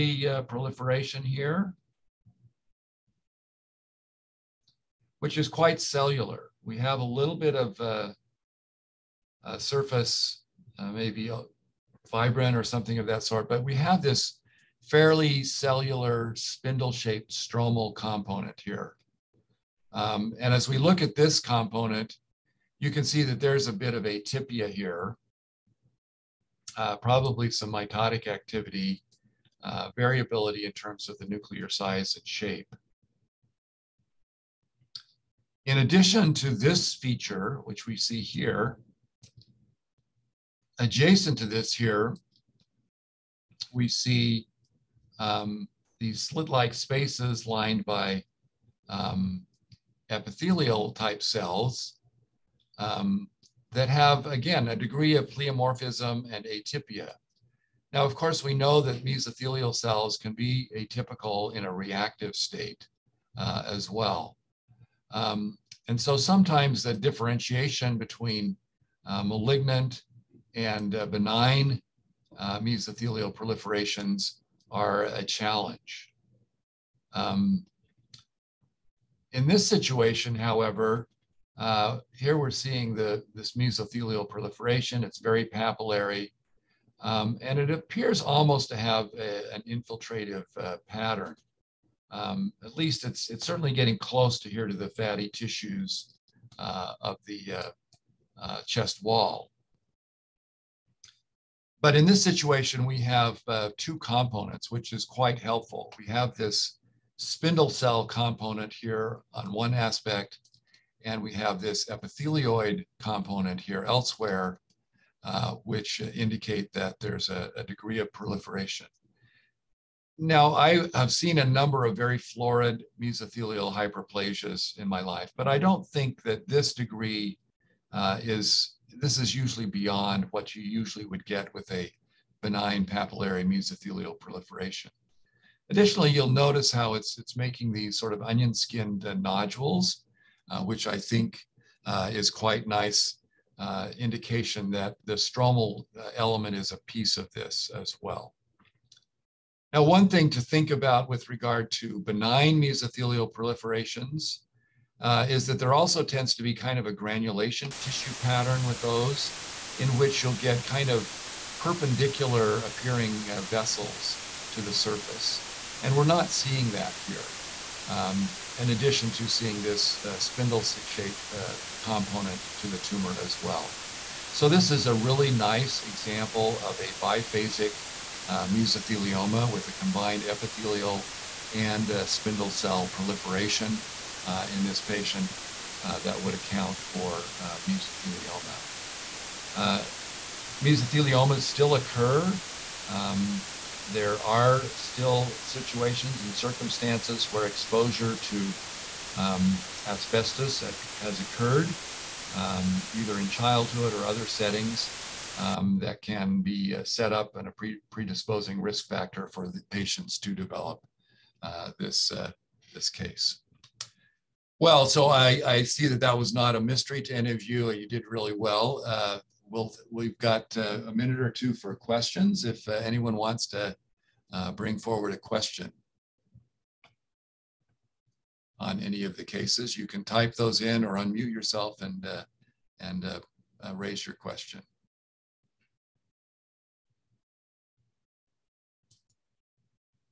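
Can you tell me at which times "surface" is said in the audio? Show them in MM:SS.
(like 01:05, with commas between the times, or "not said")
00:09, 02:44.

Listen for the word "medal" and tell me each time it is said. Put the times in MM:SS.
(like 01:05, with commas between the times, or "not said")
not said.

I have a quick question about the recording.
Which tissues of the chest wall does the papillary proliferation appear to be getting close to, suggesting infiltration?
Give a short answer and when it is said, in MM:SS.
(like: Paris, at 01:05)
Fatty tissues, at 01:34.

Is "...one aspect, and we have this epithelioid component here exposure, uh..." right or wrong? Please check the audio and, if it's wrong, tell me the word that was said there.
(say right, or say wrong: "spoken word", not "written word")
wrong: "elsewhere", not "exposure".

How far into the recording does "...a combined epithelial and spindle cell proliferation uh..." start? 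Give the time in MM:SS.
02:59.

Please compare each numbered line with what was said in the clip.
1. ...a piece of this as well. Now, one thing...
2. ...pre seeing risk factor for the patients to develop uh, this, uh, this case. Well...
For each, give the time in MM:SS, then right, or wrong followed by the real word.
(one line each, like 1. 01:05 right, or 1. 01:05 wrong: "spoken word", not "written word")
1. 02:26 right
2. 03:27 wrong: "predisposing", not "seeing".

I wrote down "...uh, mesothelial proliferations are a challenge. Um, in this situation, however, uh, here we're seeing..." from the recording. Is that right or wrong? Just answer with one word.
right.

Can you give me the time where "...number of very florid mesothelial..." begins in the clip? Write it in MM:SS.
02:01.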